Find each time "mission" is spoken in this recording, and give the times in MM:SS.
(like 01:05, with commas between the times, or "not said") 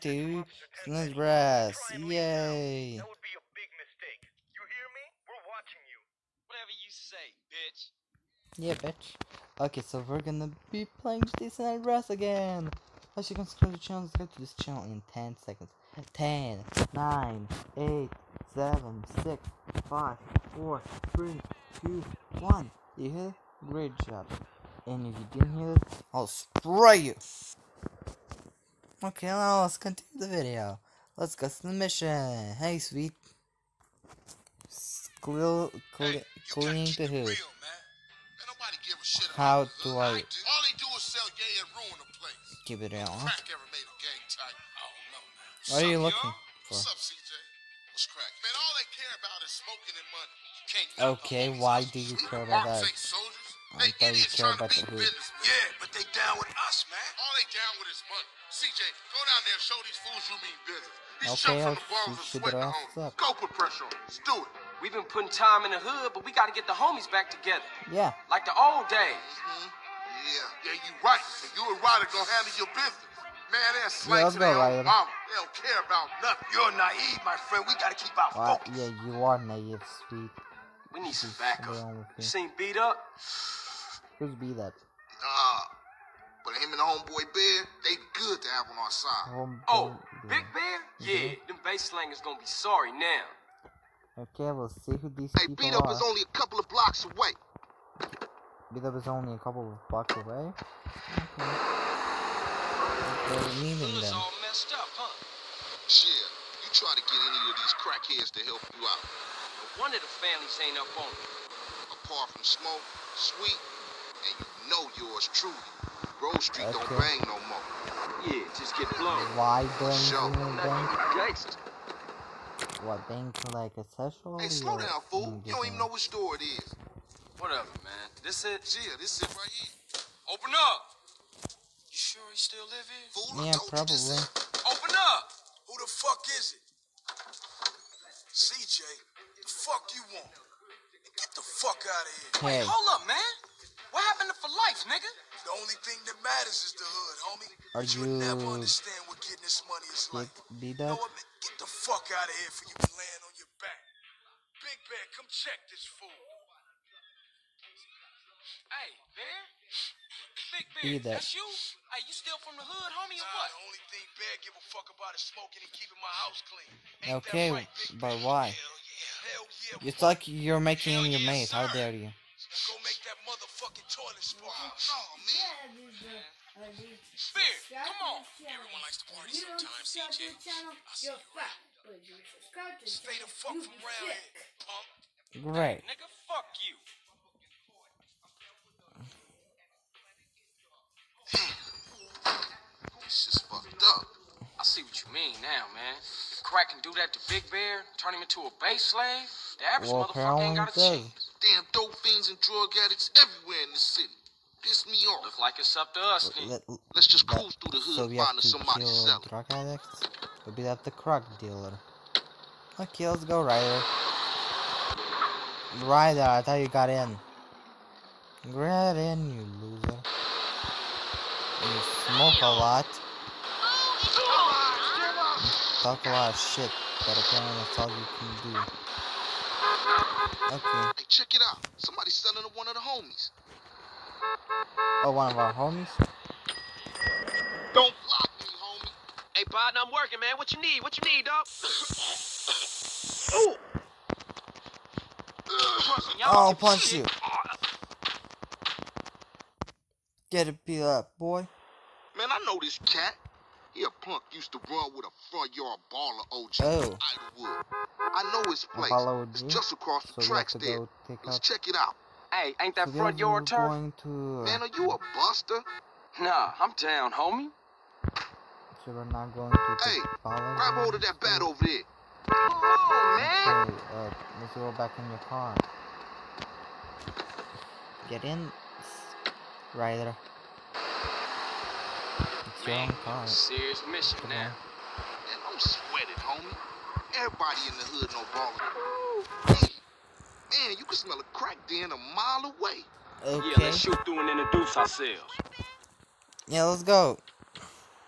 00:31, 04:43.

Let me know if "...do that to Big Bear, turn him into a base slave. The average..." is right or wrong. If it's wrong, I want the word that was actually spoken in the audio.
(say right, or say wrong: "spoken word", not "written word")
right.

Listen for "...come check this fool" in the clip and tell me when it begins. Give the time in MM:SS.
02:35.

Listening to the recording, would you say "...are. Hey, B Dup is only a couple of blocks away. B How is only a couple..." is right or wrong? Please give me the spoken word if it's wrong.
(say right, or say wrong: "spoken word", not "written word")
wrong: "Dup", not "How".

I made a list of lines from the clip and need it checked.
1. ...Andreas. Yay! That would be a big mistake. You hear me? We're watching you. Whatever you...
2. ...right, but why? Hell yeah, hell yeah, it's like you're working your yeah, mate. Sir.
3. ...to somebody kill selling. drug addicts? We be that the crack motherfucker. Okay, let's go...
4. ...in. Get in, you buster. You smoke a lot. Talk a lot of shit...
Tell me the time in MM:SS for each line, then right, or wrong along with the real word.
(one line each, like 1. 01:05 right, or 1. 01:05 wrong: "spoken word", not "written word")
1. 00:00 right
2. 02:47 wrong: "making", not "working"
3. 03:28 wrong: "dealer", not "motherfucker"
4. 03:36 wrong: "loser", not "buster".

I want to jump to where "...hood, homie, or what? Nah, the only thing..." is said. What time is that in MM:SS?
02:42.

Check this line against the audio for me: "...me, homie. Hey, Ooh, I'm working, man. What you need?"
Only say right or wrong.
wrong.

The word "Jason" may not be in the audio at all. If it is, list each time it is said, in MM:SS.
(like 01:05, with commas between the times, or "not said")
00:11.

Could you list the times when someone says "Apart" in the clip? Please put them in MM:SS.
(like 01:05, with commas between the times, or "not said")
01:52.